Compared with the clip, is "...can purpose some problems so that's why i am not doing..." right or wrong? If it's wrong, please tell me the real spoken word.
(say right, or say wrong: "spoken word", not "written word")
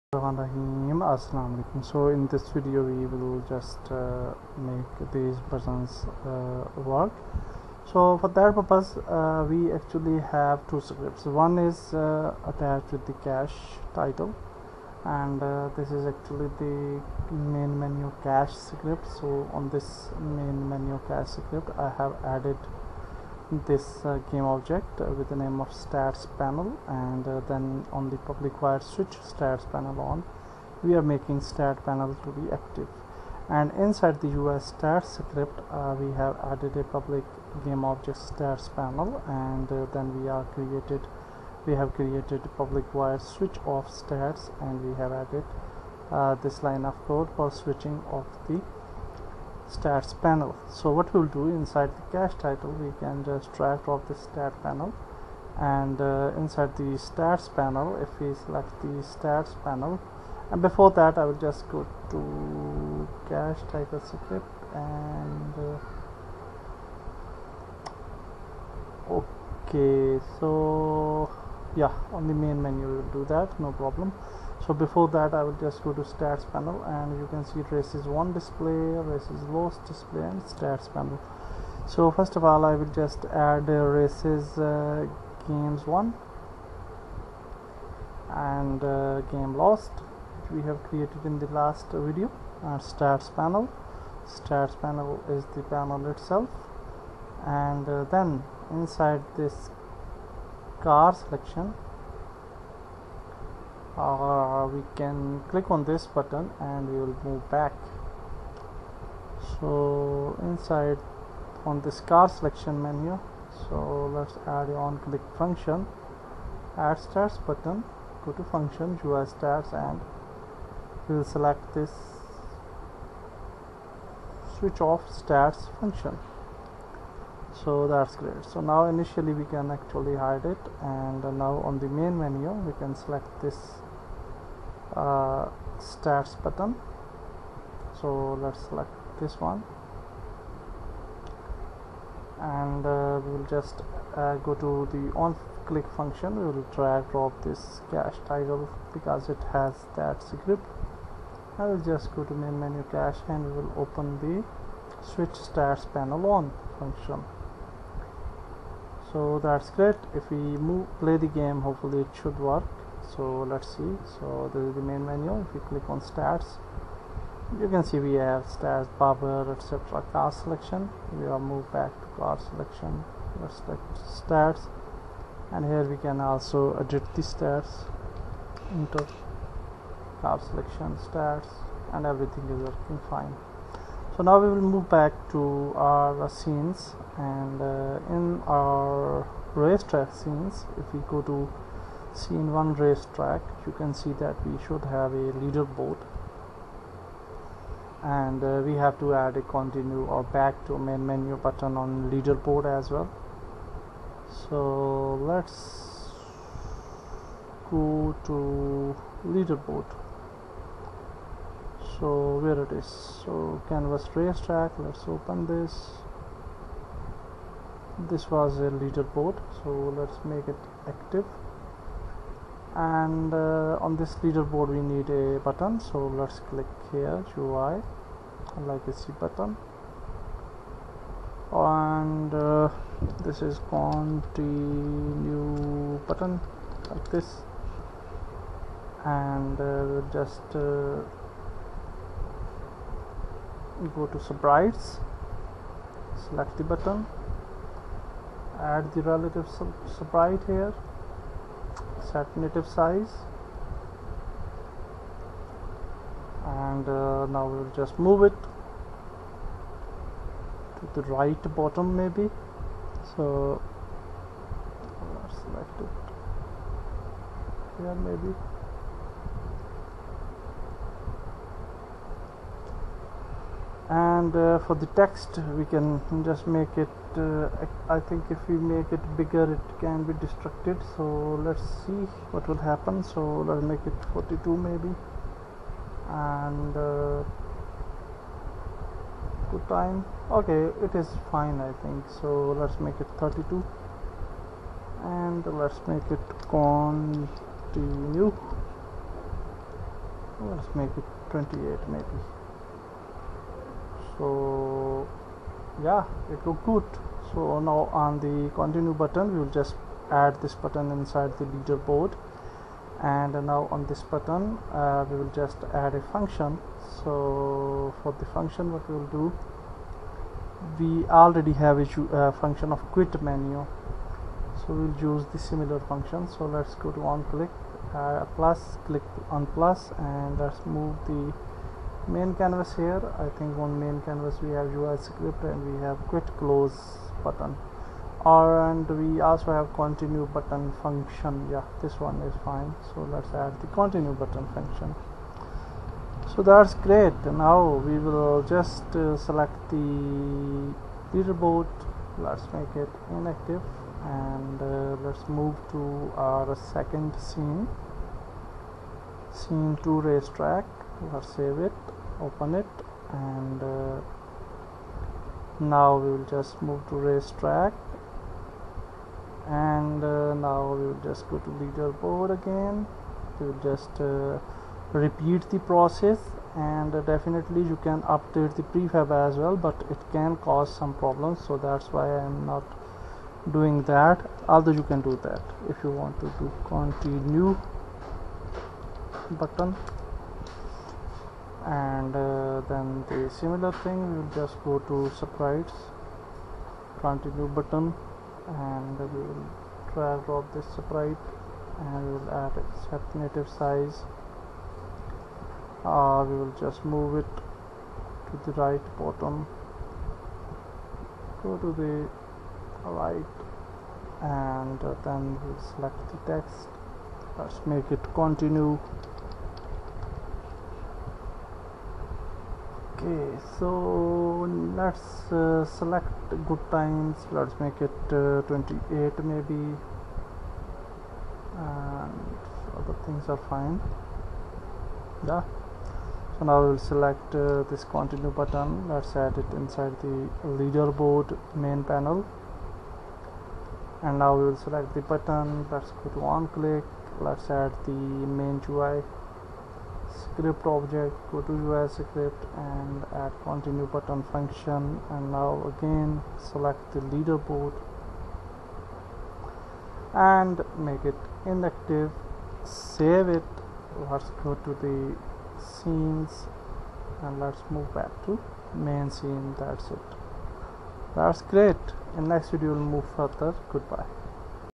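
wrong: "cause", not "purpose".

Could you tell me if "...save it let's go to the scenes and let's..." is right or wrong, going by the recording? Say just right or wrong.
right.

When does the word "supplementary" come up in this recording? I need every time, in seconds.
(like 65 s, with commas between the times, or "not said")
not said.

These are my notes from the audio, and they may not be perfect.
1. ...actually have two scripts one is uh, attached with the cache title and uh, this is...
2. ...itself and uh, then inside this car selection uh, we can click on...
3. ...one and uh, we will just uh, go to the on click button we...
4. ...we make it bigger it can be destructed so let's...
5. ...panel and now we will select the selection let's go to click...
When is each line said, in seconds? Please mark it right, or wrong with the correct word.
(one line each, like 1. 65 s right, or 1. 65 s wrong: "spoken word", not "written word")
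1. 9 s right
2. 96 s right
3. 139 s wrong: "function", not "button"
4. 278 s right
5. 441 s wrong: "button", not "selection".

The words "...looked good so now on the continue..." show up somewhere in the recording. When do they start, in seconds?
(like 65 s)
306 s.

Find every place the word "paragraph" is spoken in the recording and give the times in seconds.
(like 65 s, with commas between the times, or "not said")
not said.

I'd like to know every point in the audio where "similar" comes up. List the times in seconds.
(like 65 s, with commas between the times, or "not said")
325 s, 393 s.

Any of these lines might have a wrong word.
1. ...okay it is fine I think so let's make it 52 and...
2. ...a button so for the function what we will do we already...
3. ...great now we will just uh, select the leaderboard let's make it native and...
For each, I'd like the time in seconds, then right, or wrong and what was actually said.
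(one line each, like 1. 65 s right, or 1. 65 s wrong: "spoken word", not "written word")
1. 290 s wrong: "32", not "52"
2. 315 s wrong: "function", not "button"
3. 346 s wrong: "inactive", not "native".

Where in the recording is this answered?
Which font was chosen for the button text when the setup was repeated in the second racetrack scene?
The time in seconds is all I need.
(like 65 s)
426 s.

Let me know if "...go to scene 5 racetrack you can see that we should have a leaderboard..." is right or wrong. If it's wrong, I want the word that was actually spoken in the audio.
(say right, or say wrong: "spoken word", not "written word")
wrong: "1", not "5".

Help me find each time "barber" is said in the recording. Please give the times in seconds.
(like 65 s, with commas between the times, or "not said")
168 s.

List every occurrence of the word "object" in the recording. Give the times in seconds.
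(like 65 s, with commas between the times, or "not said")
24 s, 37 s, 450 s.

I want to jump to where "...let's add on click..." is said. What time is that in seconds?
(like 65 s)
114 s.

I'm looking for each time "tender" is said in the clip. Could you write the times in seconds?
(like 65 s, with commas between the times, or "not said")
not said.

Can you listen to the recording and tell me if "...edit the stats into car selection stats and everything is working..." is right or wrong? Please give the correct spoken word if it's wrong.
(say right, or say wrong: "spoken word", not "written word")
right.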